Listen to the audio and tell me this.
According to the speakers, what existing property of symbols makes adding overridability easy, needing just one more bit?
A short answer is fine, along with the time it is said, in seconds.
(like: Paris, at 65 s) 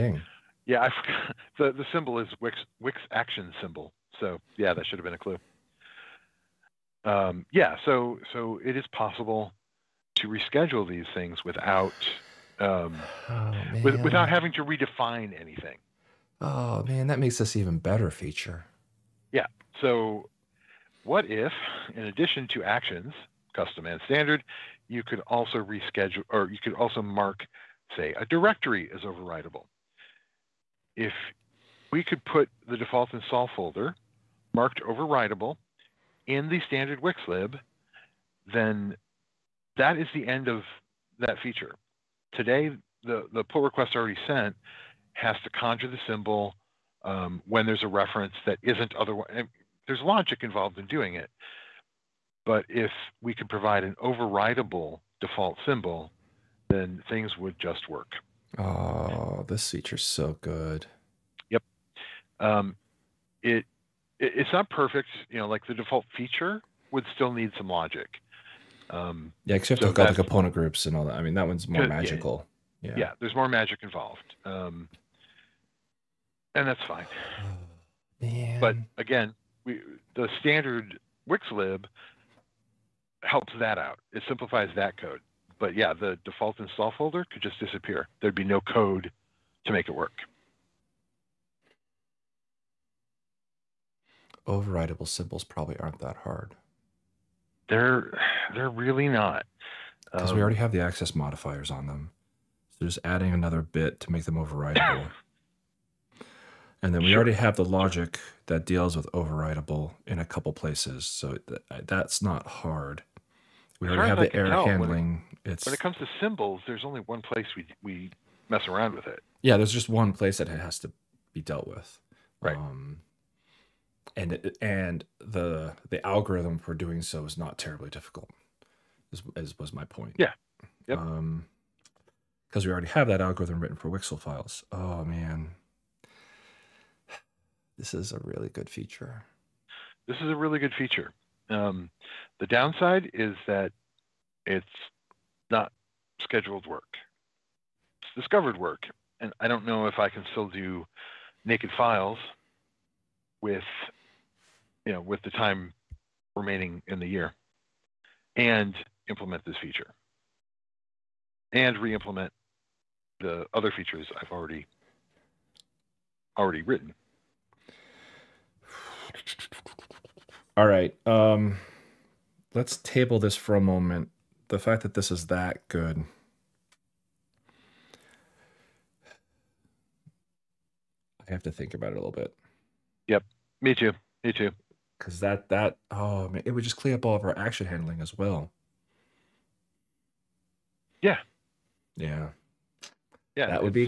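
Access modifiers, at 100 s.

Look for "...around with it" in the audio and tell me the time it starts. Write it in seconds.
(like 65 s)
118 s.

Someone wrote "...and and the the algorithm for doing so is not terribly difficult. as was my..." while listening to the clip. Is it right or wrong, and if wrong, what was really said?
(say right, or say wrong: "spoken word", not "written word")
right.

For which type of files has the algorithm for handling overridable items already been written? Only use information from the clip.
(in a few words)
Wixel files.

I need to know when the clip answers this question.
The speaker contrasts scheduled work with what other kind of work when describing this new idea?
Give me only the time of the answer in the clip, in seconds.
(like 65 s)
148 s.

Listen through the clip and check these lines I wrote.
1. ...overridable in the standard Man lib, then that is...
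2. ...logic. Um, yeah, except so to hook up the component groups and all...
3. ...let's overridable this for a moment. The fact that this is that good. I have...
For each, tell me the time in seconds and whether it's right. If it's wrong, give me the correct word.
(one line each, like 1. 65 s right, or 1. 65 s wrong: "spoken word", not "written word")
1. 34 s wrong: "Wix", not "Man"
2. 67 s right
3. 172 s wrong: "table", not "overridable".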